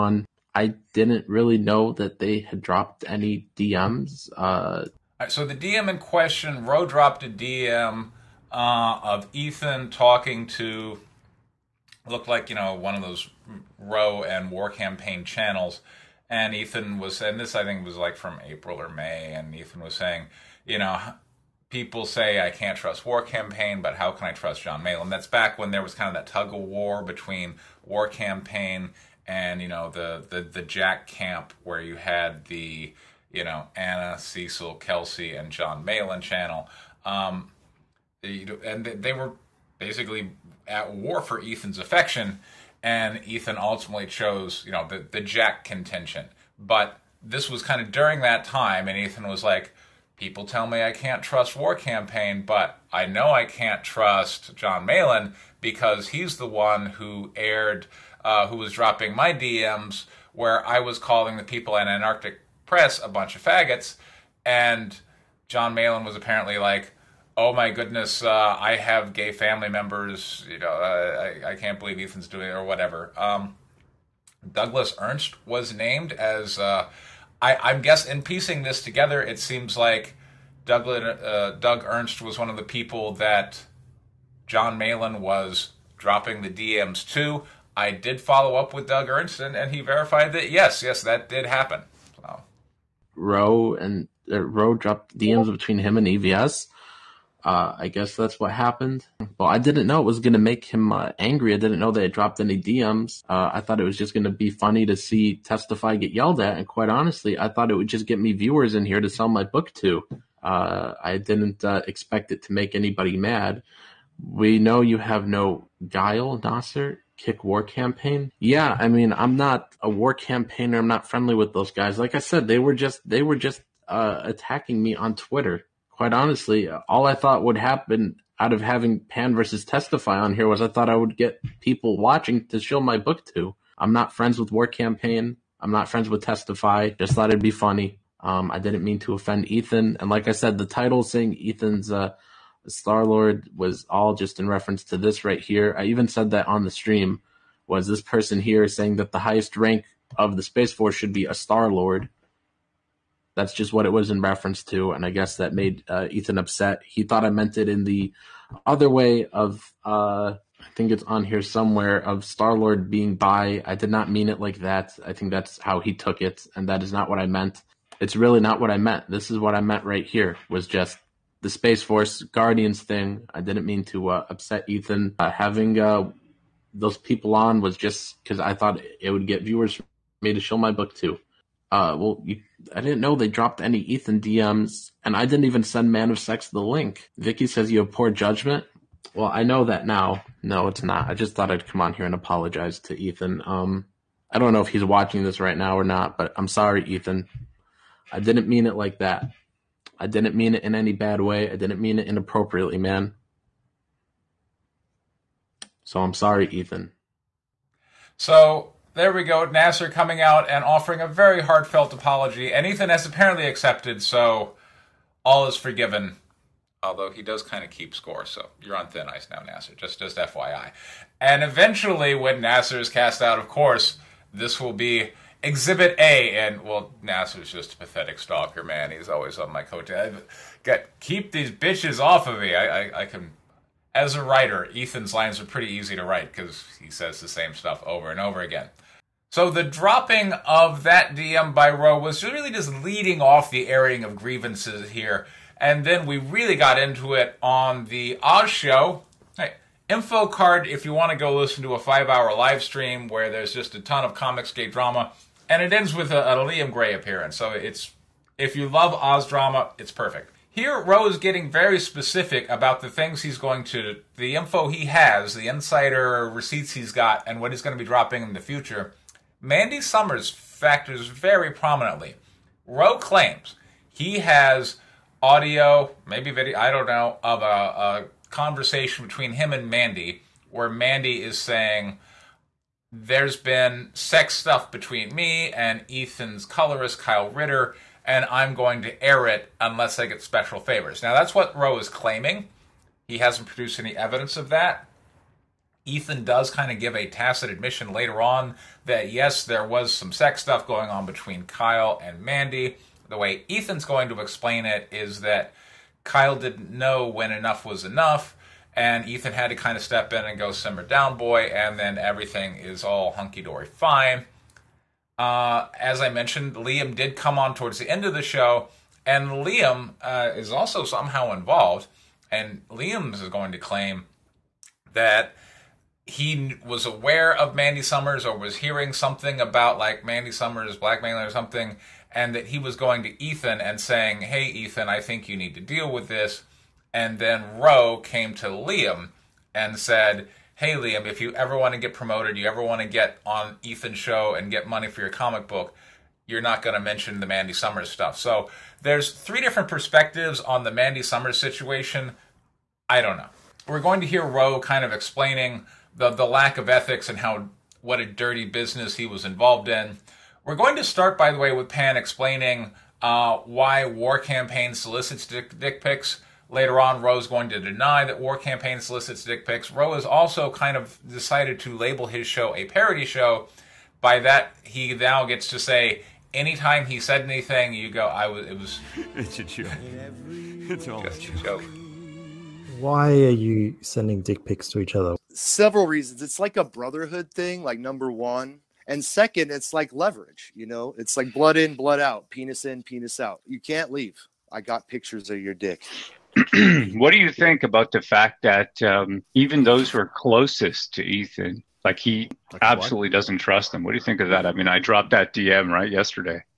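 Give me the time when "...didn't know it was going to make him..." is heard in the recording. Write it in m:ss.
1:39.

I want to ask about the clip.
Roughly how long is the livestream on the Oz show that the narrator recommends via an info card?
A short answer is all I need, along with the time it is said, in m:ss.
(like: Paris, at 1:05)
5 hours, at 4:11.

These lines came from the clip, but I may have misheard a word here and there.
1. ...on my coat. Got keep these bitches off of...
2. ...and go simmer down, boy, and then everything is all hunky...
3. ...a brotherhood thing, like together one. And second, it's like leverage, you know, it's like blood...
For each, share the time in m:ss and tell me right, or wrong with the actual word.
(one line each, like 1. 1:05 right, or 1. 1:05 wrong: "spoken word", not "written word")
1. 3:49 right
2. 5:10 right
3. 6:26 wrong: "number", not "together".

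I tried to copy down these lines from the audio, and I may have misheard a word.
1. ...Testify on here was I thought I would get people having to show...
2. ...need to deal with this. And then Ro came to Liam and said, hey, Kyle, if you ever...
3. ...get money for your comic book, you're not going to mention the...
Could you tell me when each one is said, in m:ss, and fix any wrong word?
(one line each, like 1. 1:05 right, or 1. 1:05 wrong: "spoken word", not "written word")
1. 2:09 wrong: "watching", not "having"
2. 5:35 wrong: "Liam", not "Kyle"
3. 5:44 right.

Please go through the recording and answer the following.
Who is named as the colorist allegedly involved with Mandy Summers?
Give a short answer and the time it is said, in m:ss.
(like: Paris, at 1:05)
Kyle Ritter, at 4:46.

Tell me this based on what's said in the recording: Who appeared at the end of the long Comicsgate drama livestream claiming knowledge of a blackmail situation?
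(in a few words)
Liam Gray.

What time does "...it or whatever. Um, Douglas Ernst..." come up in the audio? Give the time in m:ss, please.
1:12.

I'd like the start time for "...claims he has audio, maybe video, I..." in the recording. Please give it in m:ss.
4:32.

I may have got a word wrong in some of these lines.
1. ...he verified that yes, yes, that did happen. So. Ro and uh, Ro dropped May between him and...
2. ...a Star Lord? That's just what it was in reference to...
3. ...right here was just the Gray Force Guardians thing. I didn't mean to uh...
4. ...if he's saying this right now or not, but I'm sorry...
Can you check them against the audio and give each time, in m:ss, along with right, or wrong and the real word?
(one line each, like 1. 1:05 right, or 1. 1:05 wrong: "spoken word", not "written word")
1. 1:29 wrong: "DMs", not "May"
2. 2:31 right
3. 2:49 wrong: "Space", not "Gray"
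4. 3:14 wrong: "watching", not "saying".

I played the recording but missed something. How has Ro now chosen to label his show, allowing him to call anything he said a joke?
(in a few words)
a parody show.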